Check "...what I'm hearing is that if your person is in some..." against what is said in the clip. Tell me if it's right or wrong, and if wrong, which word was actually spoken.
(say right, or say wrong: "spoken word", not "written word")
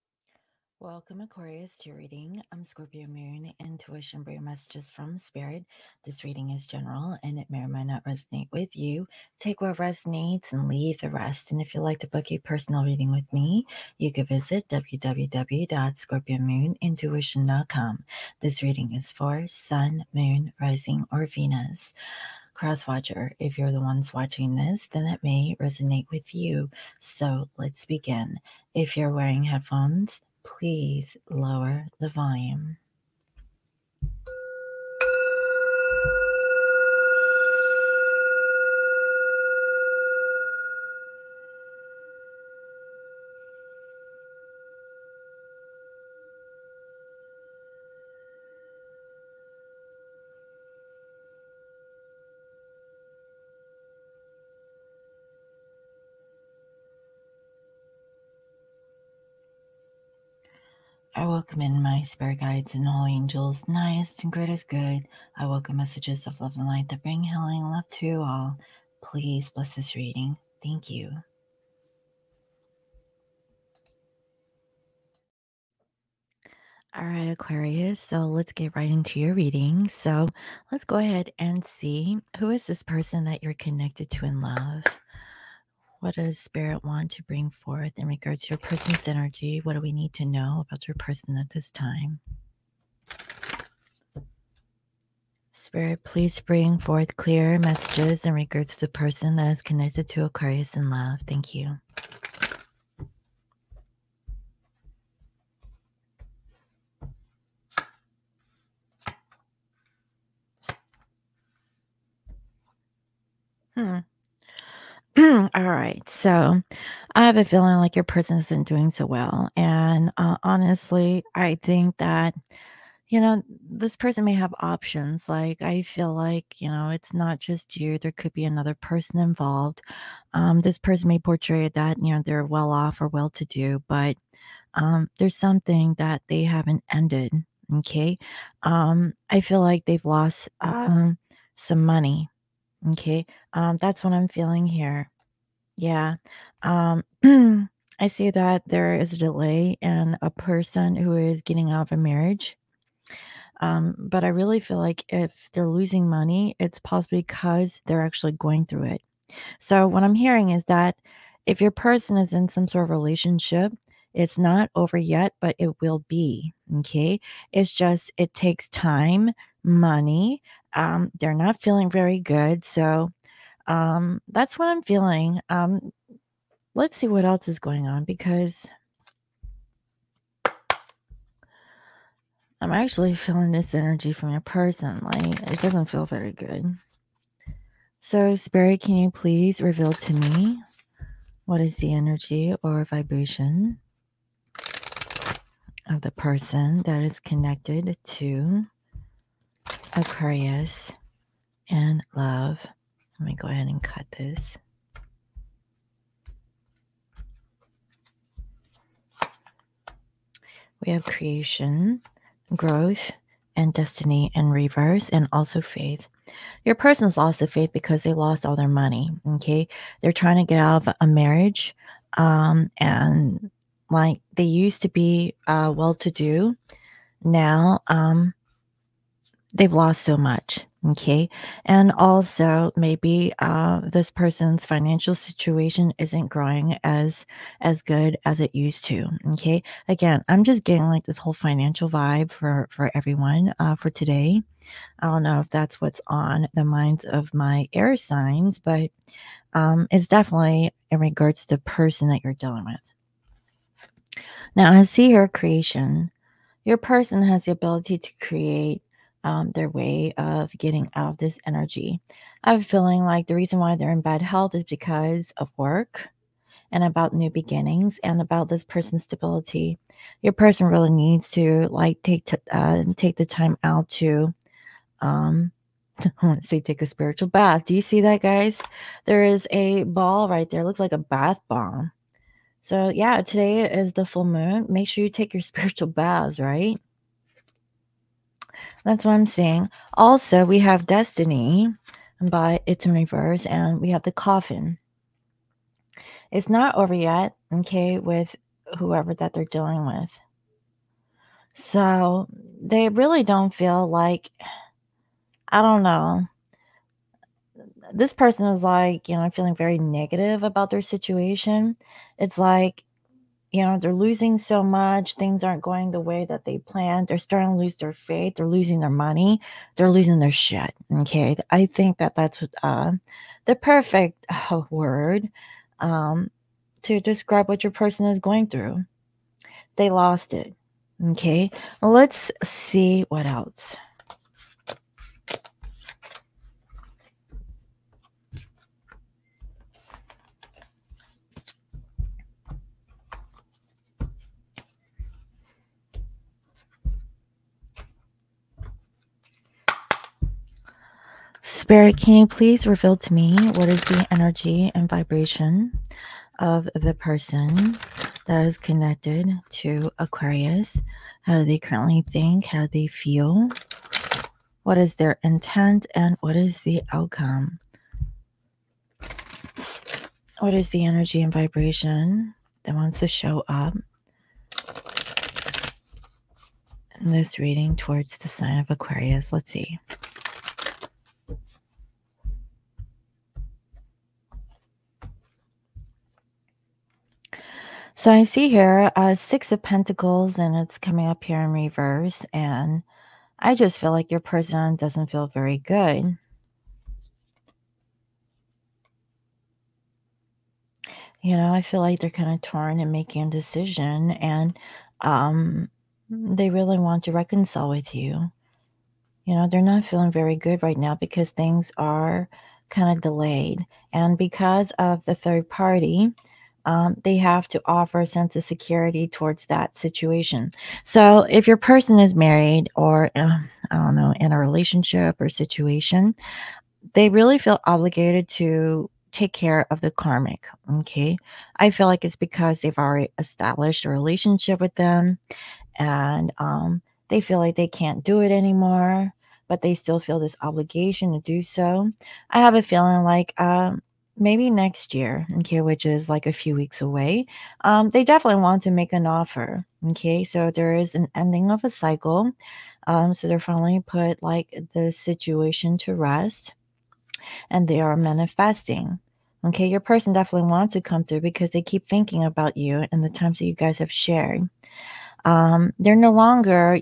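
right.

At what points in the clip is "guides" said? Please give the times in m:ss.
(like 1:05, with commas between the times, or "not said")
1:02.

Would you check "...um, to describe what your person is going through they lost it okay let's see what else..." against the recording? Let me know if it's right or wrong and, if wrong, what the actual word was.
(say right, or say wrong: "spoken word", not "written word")
right.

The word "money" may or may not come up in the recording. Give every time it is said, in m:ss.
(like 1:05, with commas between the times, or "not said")
2:21, 2:36, 2:49, 3:38, 5:18.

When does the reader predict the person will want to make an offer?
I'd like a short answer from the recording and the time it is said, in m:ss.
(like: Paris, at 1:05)
next year, at 7:24.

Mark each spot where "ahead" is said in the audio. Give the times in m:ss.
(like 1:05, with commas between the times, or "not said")
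1:20, 3:23.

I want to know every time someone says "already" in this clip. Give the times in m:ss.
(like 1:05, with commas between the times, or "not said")
7:12.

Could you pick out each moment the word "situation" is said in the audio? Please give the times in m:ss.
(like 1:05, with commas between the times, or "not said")
3:55, 5:10, 6:59, 7:05, 7:34.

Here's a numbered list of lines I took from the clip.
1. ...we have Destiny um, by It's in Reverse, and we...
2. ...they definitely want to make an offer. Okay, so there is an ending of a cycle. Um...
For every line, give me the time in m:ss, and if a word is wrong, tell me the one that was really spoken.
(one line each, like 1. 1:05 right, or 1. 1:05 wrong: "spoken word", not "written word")
1. 4:50 right
2. 7:27 right.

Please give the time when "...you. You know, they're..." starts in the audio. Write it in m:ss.
6:47.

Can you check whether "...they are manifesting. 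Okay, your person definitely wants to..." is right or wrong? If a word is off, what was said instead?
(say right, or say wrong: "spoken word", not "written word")
right.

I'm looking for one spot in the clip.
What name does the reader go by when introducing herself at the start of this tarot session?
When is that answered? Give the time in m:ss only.
0:02.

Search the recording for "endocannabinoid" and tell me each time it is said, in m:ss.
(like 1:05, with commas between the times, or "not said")
not said.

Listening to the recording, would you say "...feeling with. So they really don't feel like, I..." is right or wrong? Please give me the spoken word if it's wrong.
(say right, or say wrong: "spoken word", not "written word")
wrong: "dealing", not "feeling".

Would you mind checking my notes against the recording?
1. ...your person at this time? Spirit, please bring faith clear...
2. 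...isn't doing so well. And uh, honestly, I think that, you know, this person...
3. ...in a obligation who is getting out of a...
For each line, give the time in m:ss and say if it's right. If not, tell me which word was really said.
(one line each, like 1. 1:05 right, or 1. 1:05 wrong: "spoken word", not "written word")
1. 1:30 wrong: "forth", not "faith"
2. 1:58 right
3. 2:29 wrong: "person", not "obligation".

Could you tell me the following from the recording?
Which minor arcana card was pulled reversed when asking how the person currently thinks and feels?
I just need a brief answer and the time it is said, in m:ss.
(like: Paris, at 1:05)
Six of Pentacles, at 6:29.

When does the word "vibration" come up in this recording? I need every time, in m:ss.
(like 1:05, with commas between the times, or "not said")
3:12, 5:54, 6:11.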